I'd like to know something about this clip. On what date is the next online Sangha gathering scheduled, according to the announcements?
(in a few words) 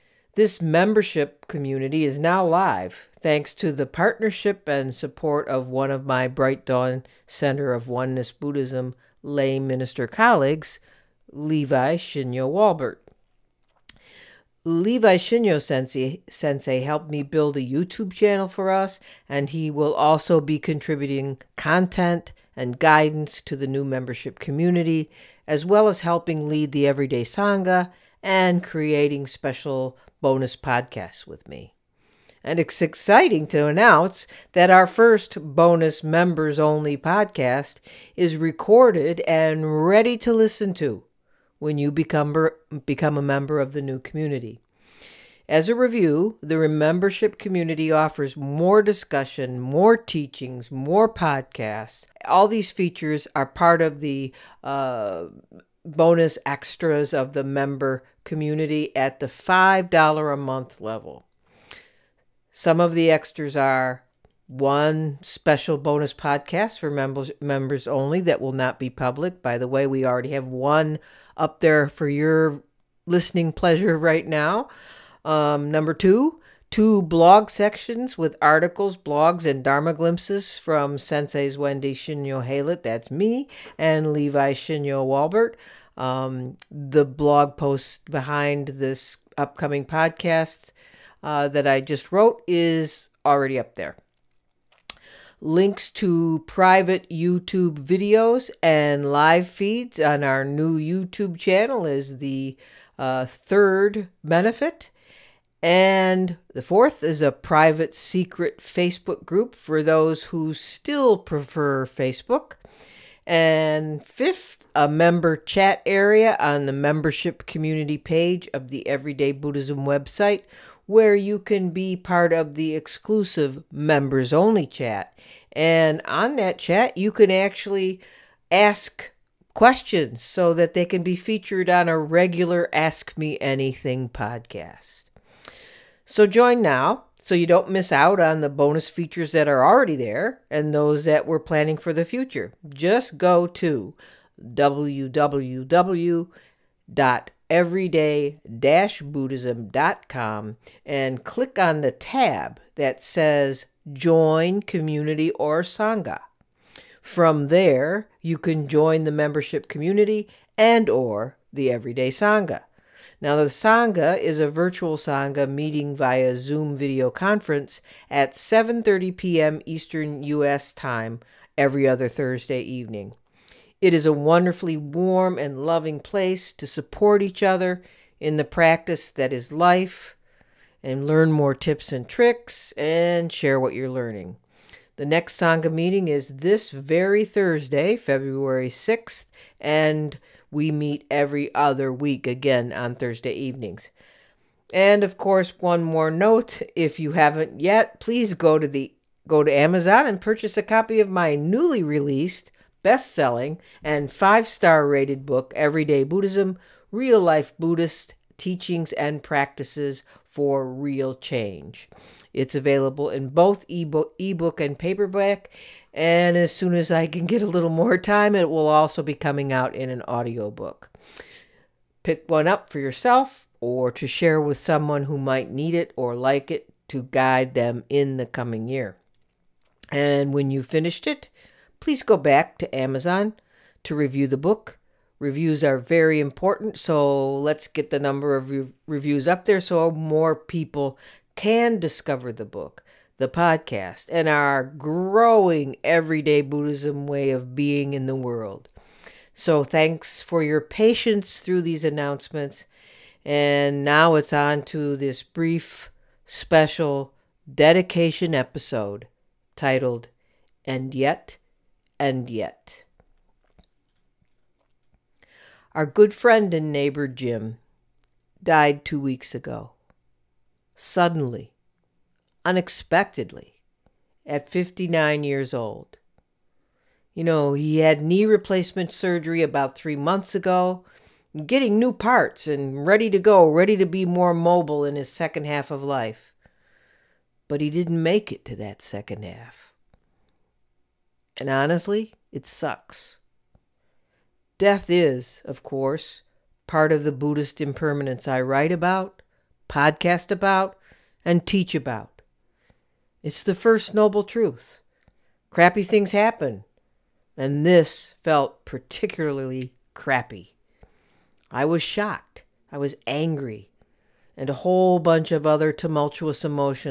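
February 6th.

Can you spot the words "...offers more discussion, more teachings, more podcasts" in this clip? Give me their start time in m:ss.
0:47.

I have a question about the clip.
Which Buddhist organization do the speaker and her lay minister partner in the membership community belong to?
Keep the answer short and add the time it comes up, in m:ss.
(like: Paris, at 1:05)
Bright Dawn Center of Oneness Buddhism, at 0:06.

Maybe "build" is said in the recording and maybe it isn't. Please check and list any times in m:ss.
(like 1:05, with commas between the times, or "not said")
0:17.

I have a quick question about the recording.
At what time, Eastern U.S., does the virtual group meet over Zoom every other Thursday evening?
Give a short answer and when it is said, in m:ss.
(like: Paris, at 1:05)
7:30 p.m., at 2:48.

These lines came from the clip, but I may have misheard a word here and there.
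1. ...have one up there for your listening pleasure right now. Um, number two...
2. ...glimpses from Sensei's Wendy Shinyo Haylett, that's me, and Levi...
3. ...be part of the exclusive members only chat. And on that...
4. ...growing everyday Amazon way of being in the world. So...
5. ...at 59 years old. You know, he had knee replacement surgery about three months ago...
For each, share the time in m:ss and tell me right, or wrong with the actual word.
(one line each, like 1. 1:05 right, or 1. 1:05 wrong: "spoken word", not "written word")
1. 1:10 right
2. 1:19 right
3. 2:01 right
4. 4:04 wrong: "Buddhism", not "Amazon"
5. 4:34 right.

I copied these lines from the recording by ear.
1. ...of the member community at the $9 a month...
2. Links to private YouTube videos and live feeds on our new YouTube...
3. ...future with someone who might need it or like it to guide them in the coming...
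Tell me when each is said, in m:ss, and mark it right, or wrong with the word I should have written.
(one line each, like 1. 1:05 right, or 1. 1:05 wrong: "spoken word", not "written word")
1. 0:57 wrong: "5", not "9"
2. 1:35 right
3. 3:44 wrong: "share", not "future".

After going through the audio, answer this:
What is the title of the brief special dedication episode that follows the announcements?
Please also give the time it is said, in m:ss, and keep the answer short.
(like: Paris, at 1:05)
And Yet, and Yet, at 4:20.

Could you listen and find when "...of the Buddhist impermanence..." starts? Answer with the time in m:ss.
4:56.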